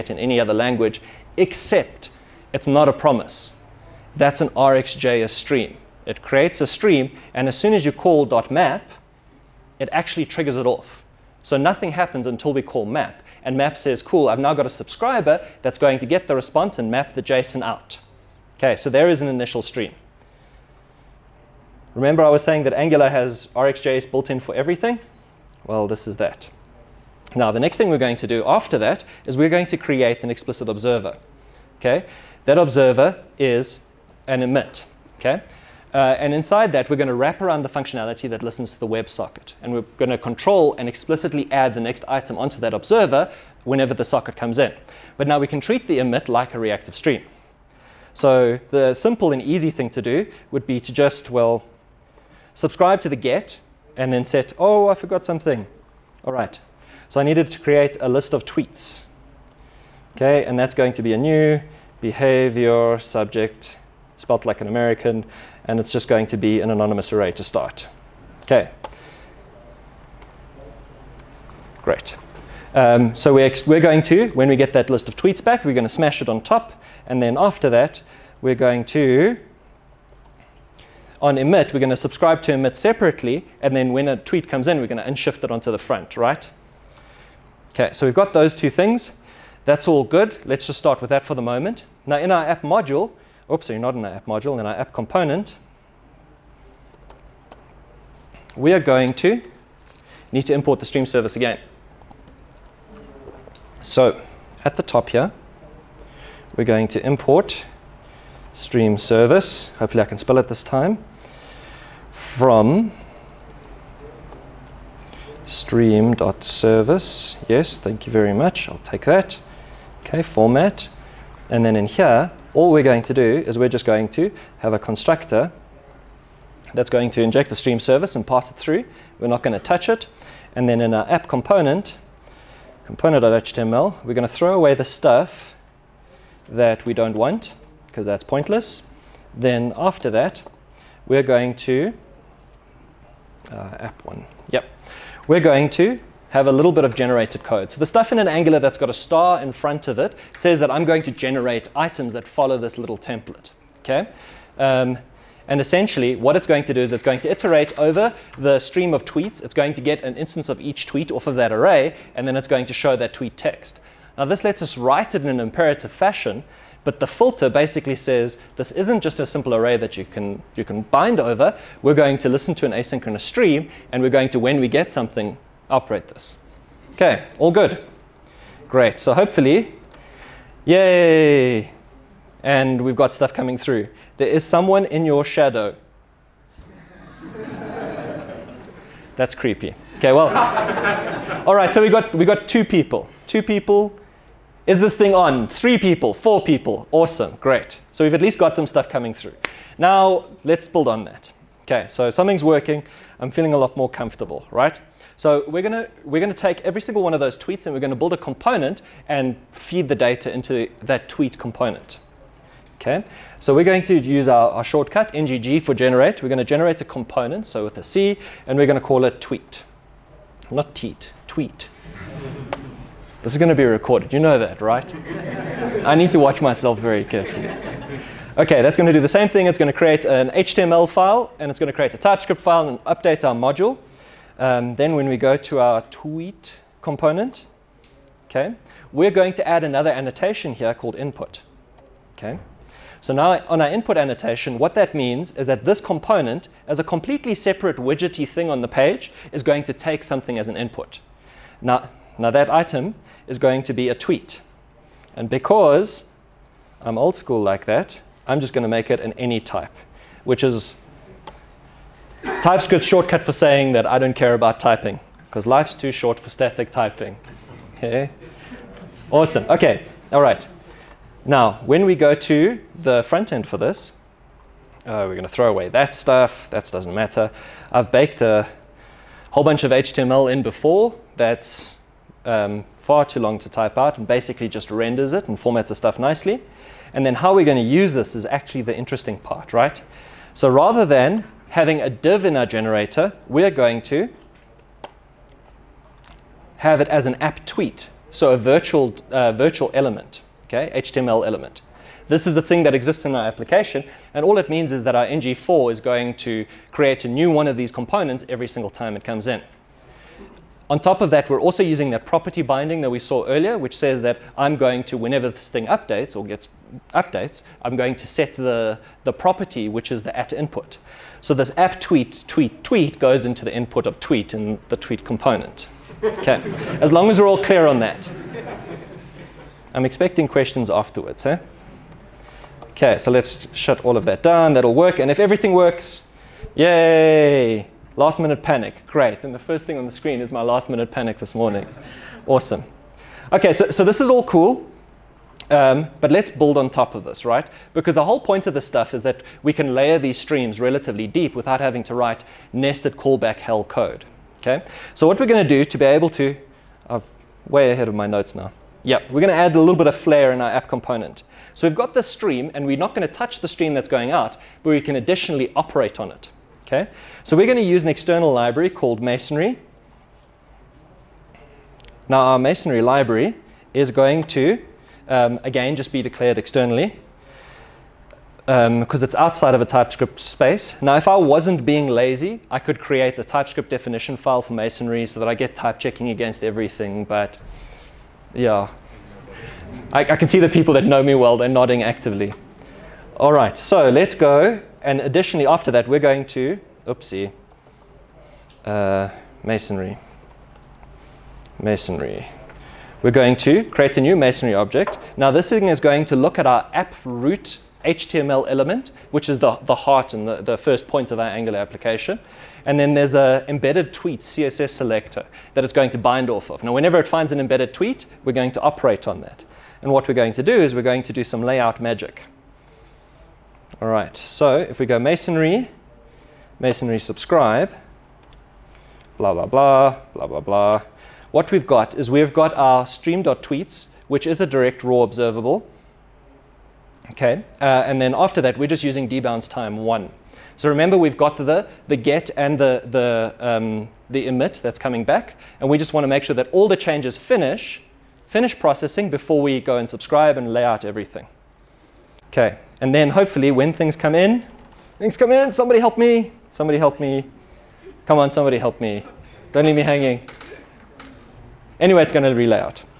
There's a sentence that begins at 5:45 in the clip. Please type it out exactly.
Um, but let's build on top of this, right?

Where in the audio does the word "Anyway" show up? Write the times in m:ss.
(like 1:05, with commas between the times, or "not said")
7:41.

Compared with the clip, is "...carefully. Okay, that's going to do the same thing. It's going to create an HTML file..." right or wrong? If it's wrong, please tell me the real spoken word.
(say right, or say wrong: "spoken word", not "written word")
right.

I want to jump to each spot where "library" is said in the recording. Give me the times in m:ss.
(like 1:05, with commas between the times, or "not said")
6:08, 6:12.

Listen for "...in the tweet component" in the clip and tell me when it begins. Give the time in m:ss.
5:24.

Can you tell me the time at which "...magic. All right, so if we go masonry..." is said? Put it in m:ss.
7:01.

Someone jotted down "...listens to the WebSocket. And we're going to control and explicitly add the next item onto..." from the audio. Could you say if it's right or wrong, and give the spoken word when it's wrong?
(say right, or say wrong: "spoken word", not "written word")
right.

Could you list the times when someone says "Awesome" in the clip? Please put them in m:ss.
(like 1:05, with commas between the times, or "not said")
3:16, 4:29, 5:42.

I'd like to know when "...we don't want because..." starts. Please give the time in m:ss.
2:16.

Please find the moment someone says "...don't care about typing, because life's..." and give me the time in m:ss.
4:23.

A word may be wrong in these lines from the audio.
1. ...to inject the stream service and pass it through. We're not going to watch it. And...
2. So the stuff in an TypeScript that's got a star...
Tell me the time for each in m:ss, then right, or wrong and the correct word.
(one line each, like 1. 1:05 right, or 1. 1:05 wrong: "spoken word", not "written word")
1. 2:07 wrong: "touch", not "watch"
2. 2:27 wrong: "Angular", not "TypeScript".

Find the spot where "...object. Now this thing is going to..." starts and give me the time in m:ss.
6:44.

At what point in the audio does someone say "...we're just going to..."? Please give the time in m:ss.
2:03.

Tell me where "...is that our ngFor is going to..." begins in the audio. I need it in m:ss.
5:04.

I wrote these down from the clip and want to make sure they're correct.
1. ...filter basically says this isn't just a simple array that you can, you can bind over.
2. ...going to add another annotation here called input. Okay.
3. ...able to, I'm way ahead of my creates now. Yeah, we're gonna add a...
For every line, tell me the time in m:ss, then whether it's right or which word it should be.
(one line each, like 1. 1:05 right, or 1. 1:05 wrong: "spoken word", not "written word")
1. 2:47 right
2. 3:59 right
3. 5:55 wrong: "notes", not "creates".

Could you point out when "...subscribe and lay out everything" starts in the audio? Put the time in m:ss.
7:29.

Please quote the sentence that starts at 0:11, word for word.
So nothing happens until we call map.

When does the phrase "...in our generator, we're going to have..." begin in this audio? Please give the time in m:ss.
4:52.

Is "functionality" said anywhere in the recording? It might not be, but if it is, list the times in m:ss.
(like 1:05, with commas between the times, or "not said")
0:37.